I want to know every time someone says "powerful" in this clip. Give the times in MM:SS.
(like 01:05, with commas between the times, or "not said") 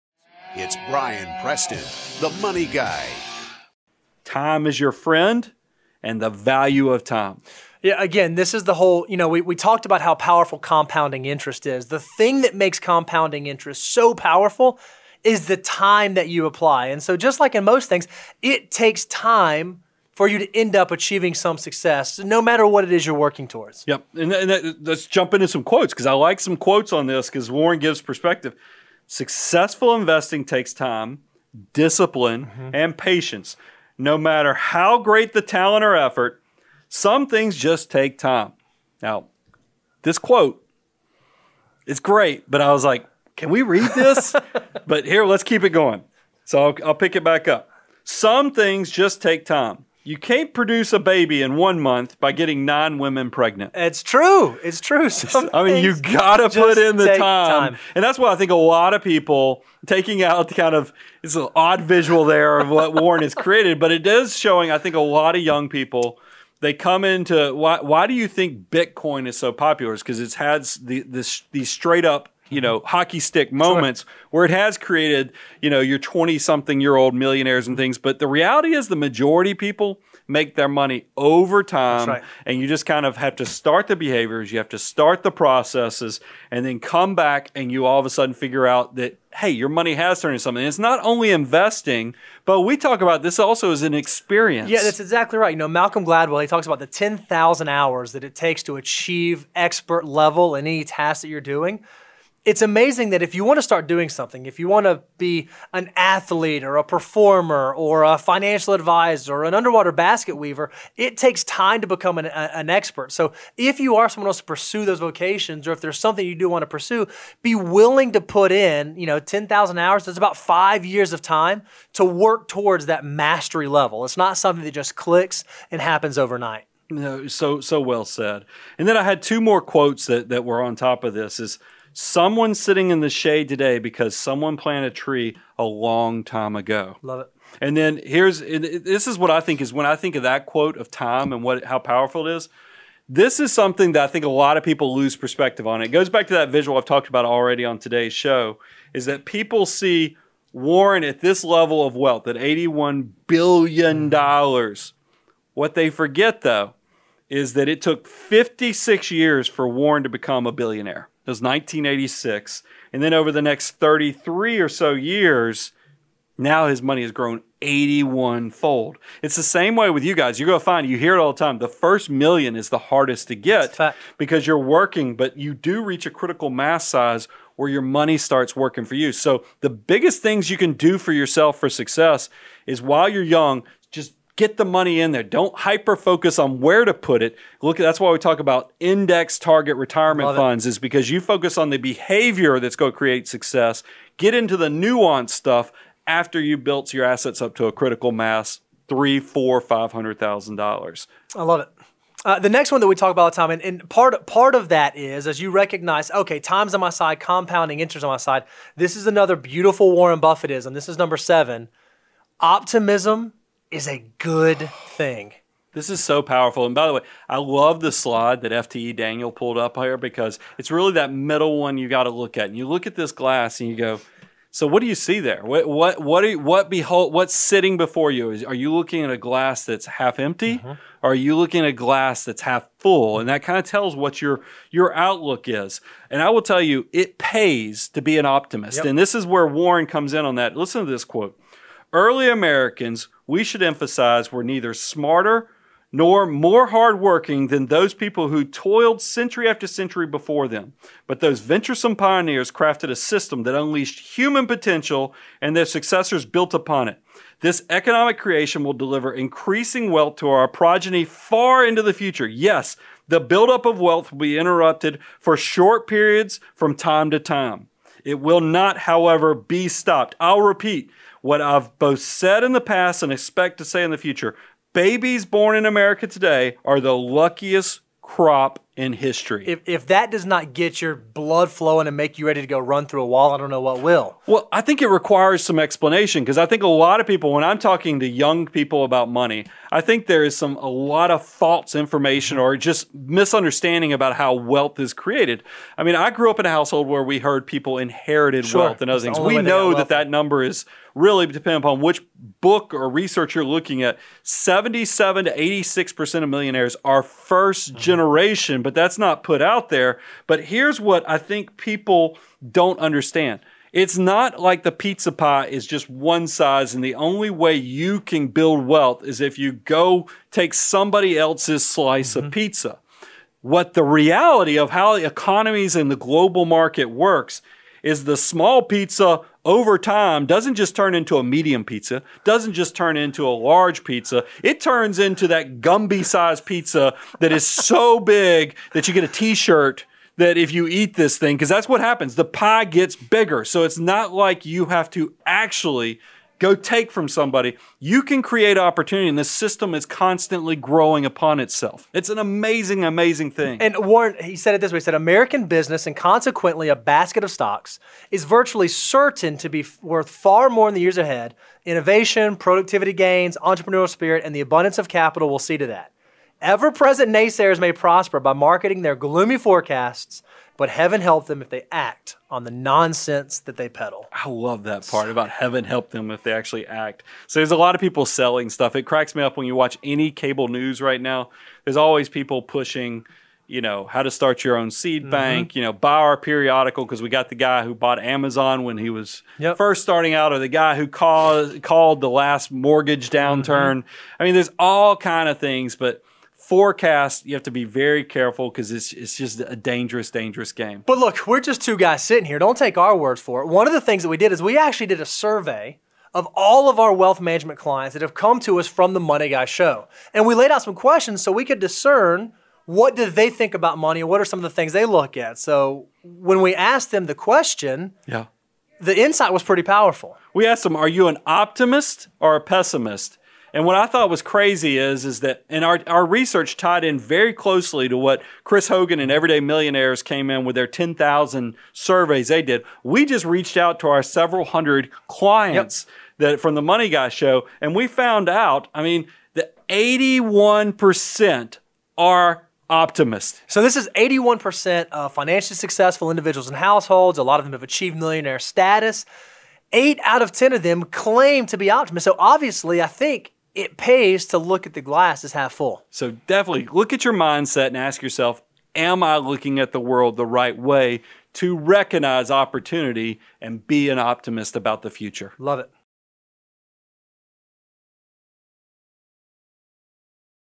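00:10, 00:14, 02:21, 03:36, 06:59.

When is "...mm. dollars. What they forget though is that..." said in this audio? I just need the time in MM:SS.
02:34.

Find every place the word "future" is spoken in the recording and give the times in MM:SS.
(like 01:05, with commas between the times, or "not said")
04:21, 04:33, 07:44.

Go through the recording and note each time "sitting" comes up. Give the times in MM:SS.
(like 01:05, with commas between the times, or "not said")
02:12, 03:47, 06:42.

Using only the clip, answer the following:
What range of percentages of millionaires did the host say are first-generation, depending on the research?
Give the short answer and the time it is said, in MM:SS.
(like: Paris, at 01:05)
77 to 86%, at 05:04.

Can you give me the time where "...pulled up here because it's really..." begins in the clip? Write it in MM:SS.
03:39.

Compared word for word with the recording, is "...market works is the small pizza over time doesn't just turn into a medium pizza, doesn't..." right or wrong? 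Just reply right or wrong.
right.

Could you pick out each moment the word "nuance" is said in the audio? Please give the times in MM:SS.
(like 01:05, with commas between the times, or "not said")
03:14.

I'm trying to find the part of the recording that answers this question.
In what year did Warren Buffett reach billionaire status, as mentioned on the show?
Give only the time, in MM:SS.
02:41.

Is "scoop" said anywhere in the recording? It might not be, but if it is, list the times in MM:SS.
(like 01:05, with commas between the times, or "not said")
not said.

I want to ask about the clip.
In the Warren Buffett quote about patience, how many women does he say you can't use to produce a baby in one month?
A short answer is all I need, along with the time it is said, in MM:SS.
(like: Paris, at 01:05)
9, at 00:52.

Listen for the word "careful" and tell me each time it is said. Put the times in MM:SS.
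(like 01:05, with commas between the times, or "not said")
06:38.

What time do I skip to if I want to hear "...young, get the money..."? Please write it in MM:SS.
03:03.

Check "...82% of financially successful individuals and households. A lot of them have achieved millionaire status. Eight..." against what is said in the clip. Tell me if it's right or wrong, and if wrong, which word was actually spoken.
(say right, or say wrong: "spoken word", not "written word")
wrong: "81", not "82".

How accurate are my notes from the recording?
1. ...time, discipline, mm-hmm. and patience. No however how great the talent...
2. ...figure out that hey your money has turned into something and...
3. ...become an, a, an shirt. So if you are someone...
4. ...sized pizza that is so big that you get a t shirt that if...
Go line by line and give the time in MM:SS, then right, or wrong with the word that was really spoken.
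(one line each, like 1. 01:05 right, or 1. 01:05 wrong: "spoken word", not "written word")
1. 00:30 wrong: "matter", not "however"
2. 01:28 right
3. 01:51 wrong: "expert", not "shirt"
4. 05:36 right.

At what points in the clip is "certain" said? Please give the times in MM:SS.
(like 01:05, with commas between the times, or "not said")
05:58.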